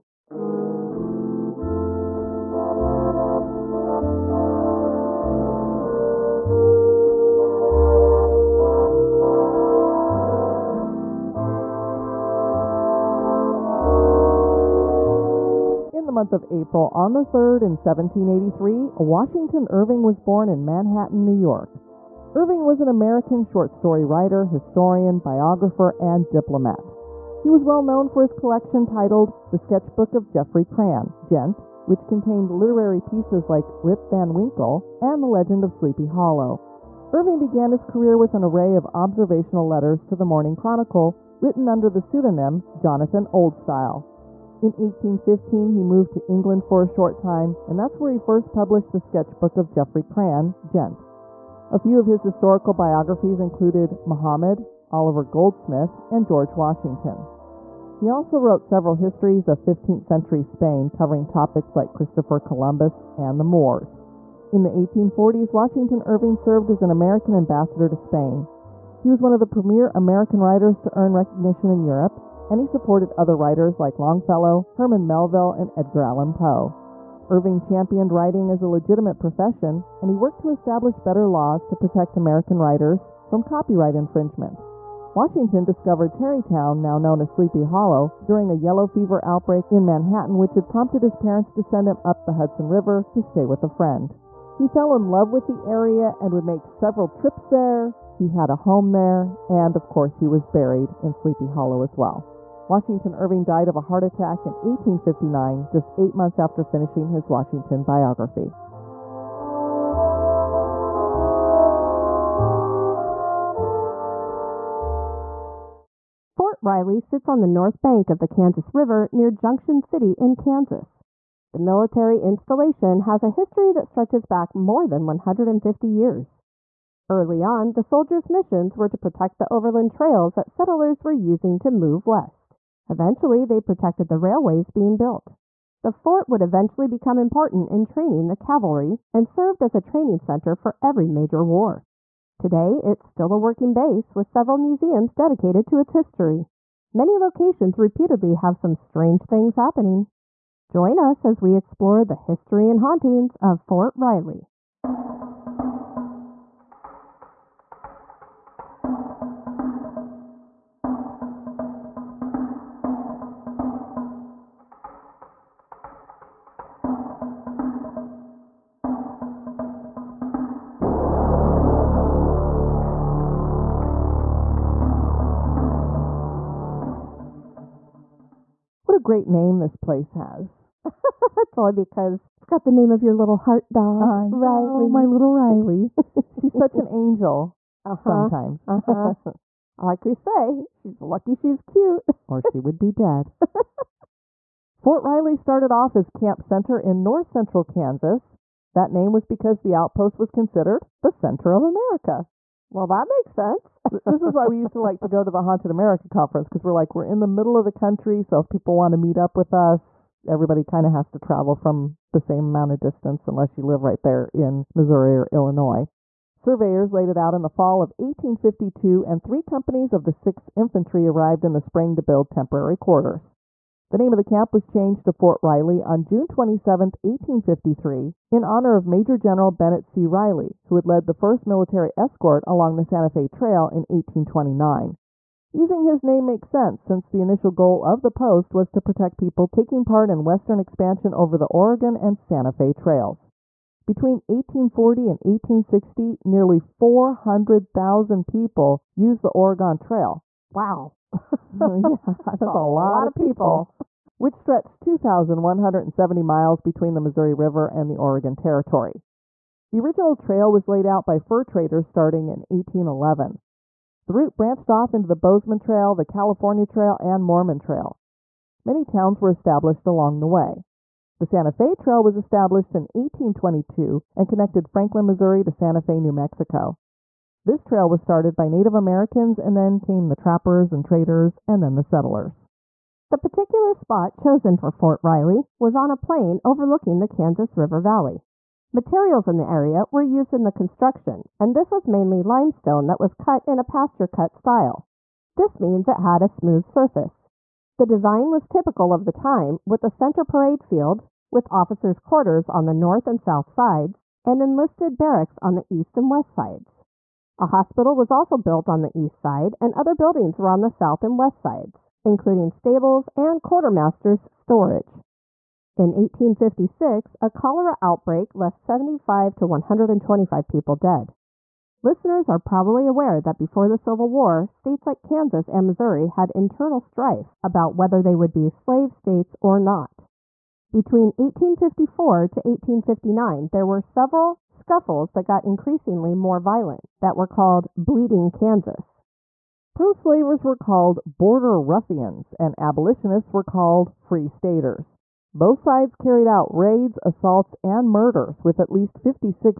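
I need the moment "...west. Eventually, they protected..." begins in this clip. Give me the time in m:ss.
2:12.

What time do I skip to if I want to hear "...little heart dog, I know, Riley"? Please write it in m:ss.
3:03.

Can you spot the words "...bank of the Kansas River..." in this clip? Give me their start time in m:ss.
1:57.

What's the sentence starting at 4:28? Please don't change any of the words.
Many towns were established along the way.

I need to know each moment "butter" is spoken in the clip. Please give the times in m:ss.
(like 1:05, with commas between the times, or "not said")
not said.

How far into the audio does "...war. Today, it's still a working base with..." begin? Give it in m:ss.
2:21.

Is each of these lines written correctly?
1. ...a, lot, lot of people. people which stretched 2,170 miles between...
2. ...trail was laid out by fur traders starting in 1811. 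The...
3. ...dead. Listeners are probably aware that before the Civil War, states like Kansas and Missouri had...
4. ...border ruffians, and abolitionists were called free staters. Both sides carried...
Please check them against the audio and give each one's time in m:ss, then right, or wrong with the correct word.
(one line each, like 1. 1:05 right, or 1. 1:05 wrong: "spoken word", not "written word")
1. 4:12 right
2. 4:20 right
3. 5:20 right
4. 5:41 right.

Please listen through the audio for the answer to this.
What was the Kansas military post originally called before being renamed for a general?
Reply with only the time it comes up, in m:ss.
3:16.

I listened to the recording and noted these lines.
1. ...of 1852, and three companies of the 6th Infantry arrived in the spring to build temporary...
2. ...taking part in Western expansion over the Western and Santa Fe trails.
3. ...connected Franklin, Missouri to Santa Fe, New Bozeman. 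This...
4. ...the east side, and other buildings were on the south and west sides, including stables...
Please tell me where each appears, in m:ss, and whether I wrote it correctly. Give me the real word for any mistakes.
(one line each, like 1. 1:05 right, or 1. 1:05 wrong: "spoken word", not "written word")
1. 3:37 right
2. 3:59 wrong: "Oregon", not "Western"
3. 4:34 wrong: "Mexico", not "Bozeman"
4. 5:08 right.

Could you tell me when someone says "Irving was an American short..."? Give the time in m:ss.
0:22.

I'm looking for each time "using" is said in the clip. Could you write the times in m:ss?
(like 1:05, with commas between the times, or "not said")
2:11, 3:55.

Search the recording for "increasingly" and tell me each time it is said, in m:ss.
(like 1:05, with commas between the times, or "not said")
5:35.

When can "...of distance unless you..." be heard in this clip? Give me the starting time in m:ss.
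3:32.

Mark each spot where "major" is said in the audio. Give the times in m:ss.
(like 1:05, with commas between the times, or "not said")
2:21, 3:48.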